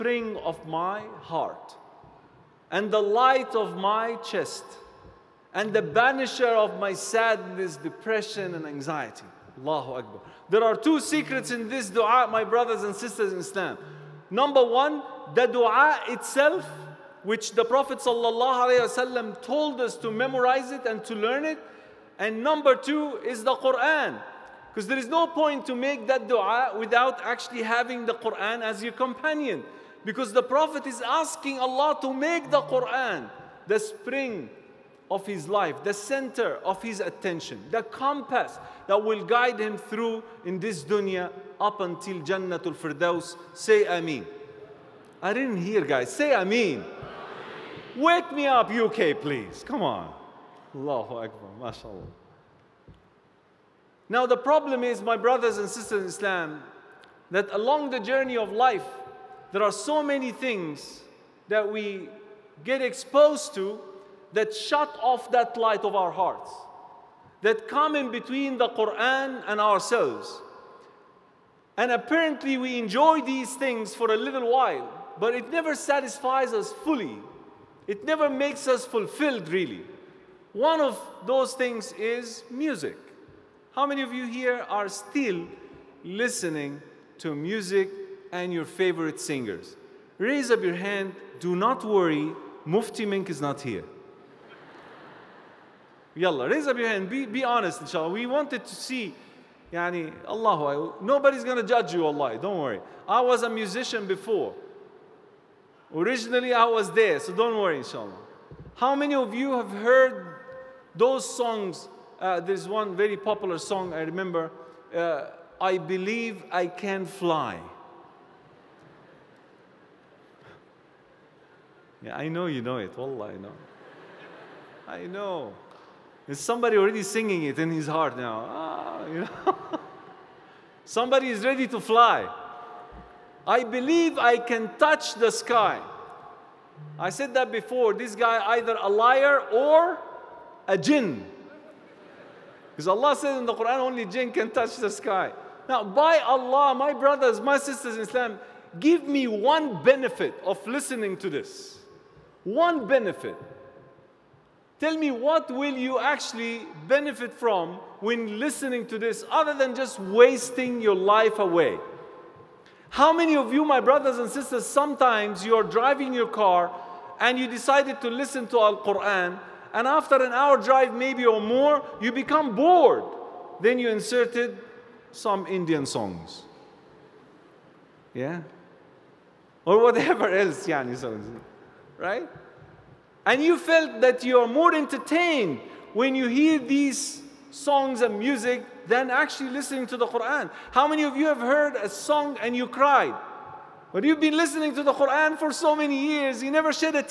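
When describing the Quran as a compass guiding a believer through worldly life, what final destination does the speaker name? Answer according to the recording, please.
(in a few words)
Jannatul Firdaus.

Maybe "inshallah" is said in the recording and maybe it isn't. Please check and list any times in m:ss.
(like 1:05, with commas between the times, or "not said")
1:37, 1:47.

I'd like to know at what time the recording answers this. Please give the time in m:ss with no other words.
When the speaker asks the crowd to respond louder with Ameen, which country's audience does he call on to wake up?
0:48.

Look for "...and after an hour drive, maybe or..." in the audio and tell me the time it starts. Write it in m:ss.
2:49.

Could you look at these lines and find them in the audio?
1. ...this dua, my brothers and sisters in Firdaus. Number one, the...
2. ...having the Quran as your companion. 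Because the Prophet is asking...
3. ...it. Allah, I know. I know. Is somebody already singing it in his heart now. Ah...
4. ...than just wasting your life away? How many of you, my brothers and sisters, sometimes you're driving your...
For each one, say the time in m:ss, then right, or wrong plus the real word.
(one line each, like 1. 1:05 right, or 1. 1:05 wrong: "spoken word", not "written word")
1. 0:11 wrong: "Islam", not "Firdaus"
2. 0:27 right
3. 2:02 right
4. 2:39 right.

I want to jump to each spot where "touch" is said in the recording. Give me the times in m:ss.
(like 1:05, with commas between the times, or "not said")
2:14, 2:24.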